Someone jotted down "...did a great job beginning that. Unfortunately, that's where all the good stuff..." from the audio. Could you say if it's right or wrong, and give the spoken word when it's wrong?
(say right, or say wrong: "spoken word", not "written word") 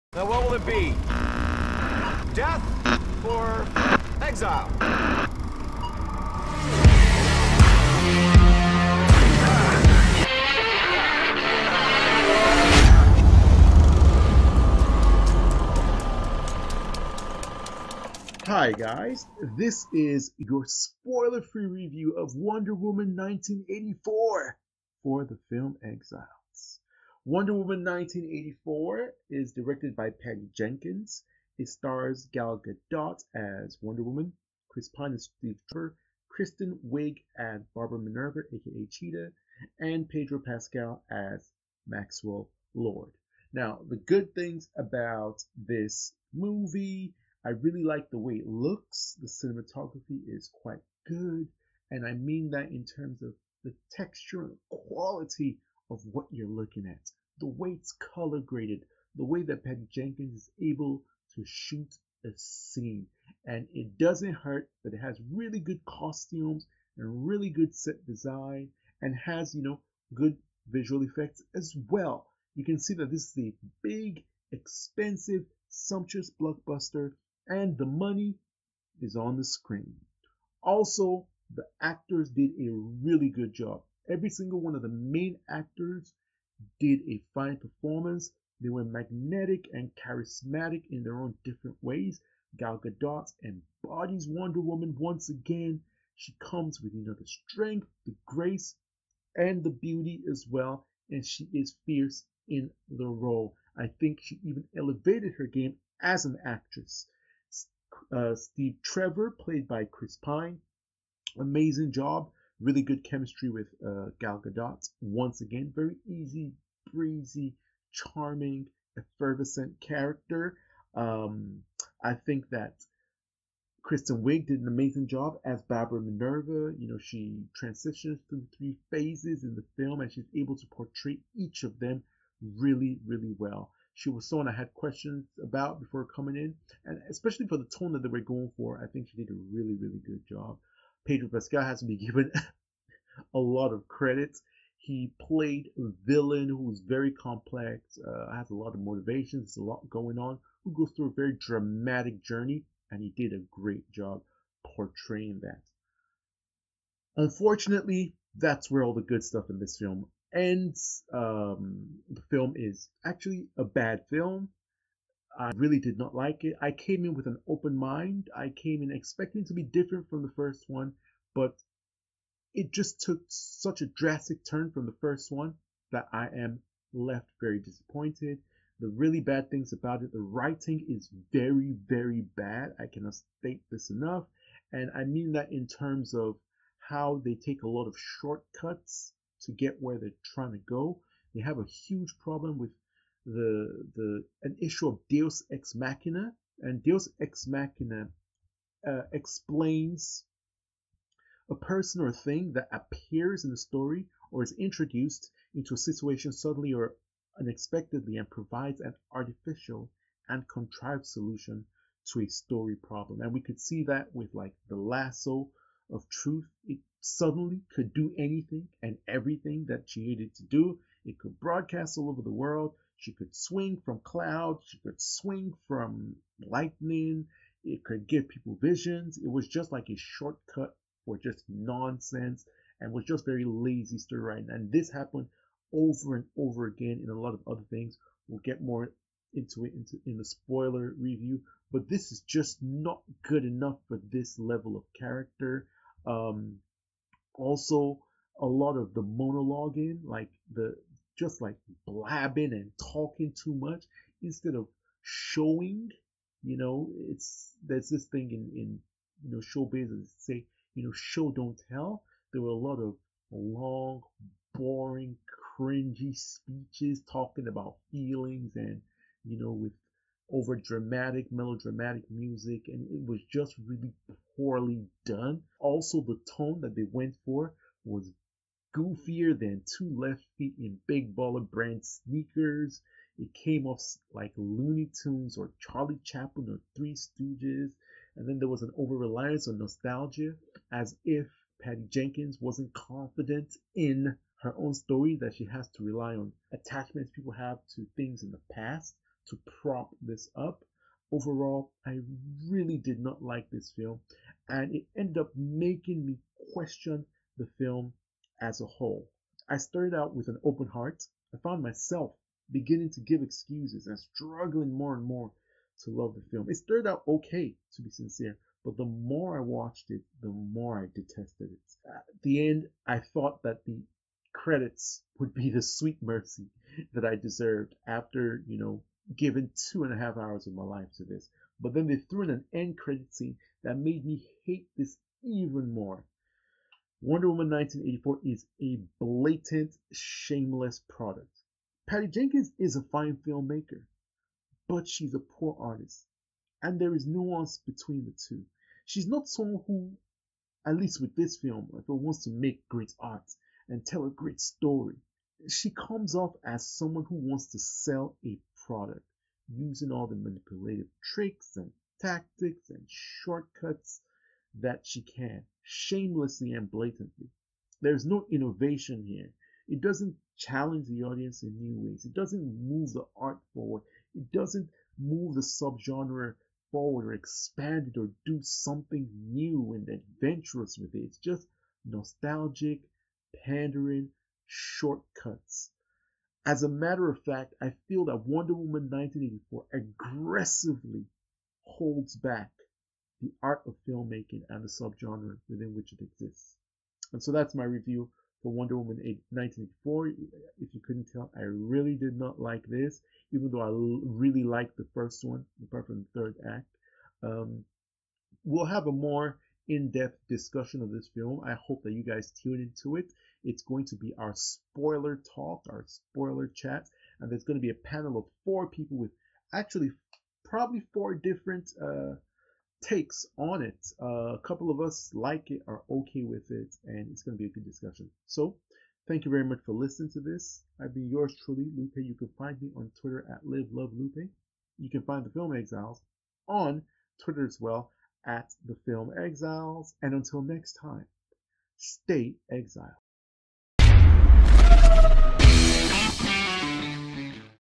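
wrong: "portraying", not "beginning".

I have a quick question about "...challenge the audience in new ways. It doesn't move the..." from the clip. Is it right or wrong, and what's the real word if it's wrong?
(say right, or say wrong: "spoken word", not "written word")
right.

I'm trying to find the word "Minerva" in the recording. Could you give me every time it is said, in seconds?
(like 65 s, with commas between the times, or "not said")
37 s, 126 s.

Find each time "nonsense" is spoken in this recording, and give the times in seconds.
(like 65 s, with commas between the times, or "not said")
231 s.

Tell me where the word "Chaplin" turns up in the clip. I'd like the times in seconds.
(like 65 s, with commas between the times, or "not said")
286 s.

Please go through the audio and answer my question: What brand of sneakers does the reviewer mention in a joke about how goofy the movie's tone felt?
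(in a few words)
Big Baller.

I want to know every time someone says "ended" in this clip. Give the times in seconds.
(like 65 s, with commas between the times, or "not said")
304 s.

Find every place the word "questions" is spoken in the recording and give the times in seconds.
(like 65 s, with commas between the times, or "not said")
134 s, 306 s.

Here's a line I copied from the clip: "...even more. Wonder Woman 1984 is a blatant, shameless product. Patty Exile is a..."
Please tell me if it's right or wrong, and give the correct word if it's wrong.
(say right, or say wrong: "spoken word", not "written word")
wrong: "Jenkins", not "Exile".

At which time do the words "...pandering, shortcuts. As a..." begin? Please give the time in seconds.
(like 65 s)
383 s.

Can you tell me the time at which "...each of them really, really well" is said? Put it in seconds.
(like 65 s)
131 s.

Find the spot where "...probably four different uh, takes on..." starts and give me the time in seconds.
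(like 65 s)
420 s.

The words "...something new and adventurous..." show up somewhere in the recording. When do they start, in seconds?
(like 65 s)
378 s.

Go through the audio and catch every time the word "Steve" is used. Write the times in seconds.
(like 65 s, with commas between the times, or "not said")
35 s, 108 s.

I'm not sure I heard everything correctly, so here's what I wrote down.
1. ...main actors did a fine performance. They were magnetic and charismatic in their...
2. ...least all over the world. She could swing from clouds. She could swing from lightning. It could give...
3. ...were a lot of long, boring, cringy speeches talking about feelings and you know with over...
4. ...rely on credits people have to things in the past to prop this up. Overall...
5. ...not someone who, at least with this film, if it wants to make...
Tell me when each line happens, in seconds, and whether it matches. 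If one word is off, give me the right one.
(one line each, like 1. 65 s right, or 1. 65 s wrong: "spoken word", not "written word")
1. 84 s right
2. 221 s wrong: "broadcast", not "least"
3. 262 s right
4. 295 s wrong: "attachments", not "credits"
5. 349 s right.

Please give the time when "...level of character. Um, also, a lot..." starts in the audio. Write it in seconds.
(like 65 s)
244 s.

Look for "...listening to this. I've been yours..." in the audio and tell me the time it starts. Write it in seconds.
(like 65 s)
429 s.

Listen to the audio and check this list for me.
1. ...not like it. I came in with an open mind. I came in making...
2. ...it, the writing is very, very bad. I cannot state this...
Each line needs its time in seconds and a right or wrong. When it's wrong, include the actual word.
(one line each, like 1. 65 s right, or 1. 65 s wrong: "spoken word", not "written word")
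1. 165 s wrong: "expecting", not "making"
2. 180 s right.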